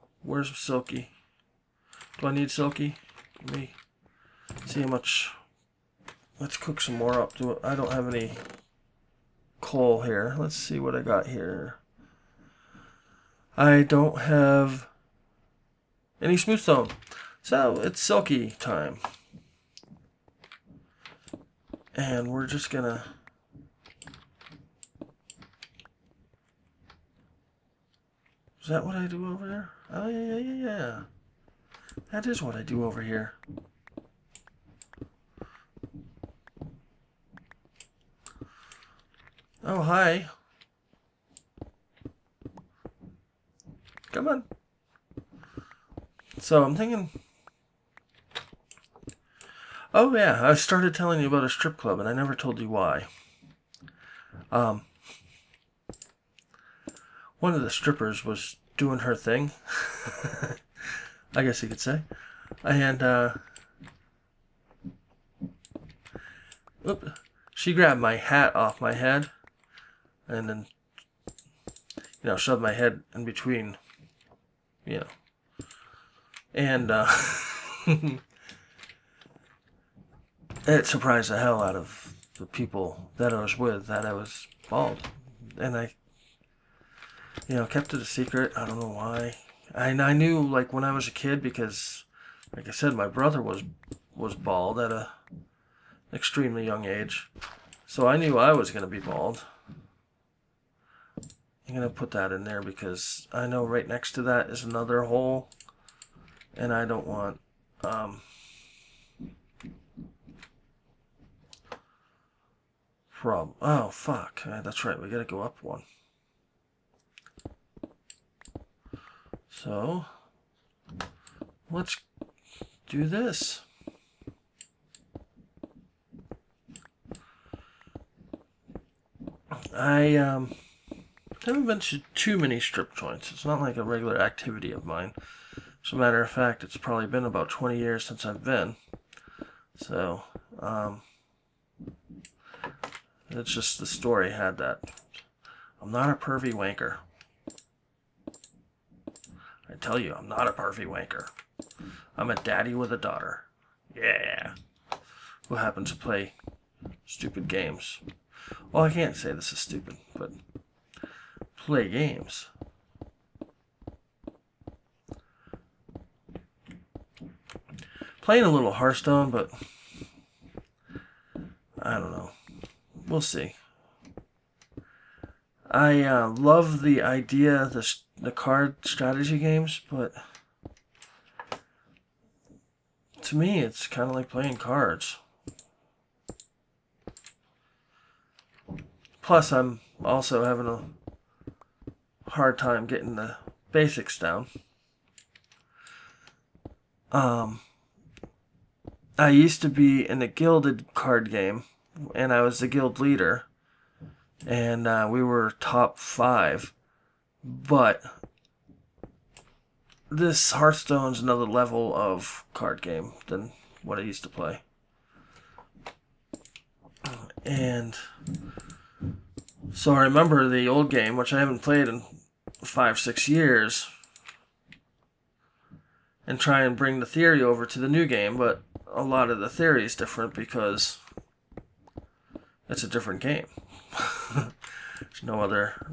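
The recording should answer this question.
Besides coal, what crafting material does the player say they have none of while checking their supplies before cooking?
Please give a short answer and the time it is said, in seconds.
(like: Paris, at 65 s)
smooth stone, at 16 s.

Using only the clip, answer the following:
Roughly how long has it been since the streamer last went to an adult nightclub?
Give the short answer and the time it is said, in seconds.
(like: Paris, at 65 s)
about 20 years, at 137 s.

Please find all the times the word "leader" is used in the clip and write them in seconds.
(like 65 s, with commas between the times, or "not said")
202 s.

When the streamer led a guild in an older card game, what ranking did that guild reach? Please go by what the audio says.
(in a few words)
top five.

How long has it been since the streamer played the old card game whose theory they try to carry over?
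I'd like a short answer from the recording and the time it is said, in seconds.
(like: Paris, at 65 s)
5 or 6 years, at 222 s.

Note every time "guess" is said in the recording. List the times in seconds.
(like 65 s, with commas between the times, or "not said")
61 s.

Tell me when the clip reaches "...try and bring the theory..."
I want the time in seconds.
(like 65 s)
226 s.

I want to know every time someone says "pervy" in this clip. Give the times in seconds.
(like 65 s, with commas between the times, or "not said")
146 s, 150 s.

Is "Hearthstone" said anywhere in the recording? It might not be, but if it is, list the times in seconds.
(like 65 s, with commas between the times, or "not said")
168 s, 210 s.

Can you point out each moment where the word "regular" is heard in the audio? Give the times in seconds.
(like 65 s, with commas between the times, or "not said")
133 s.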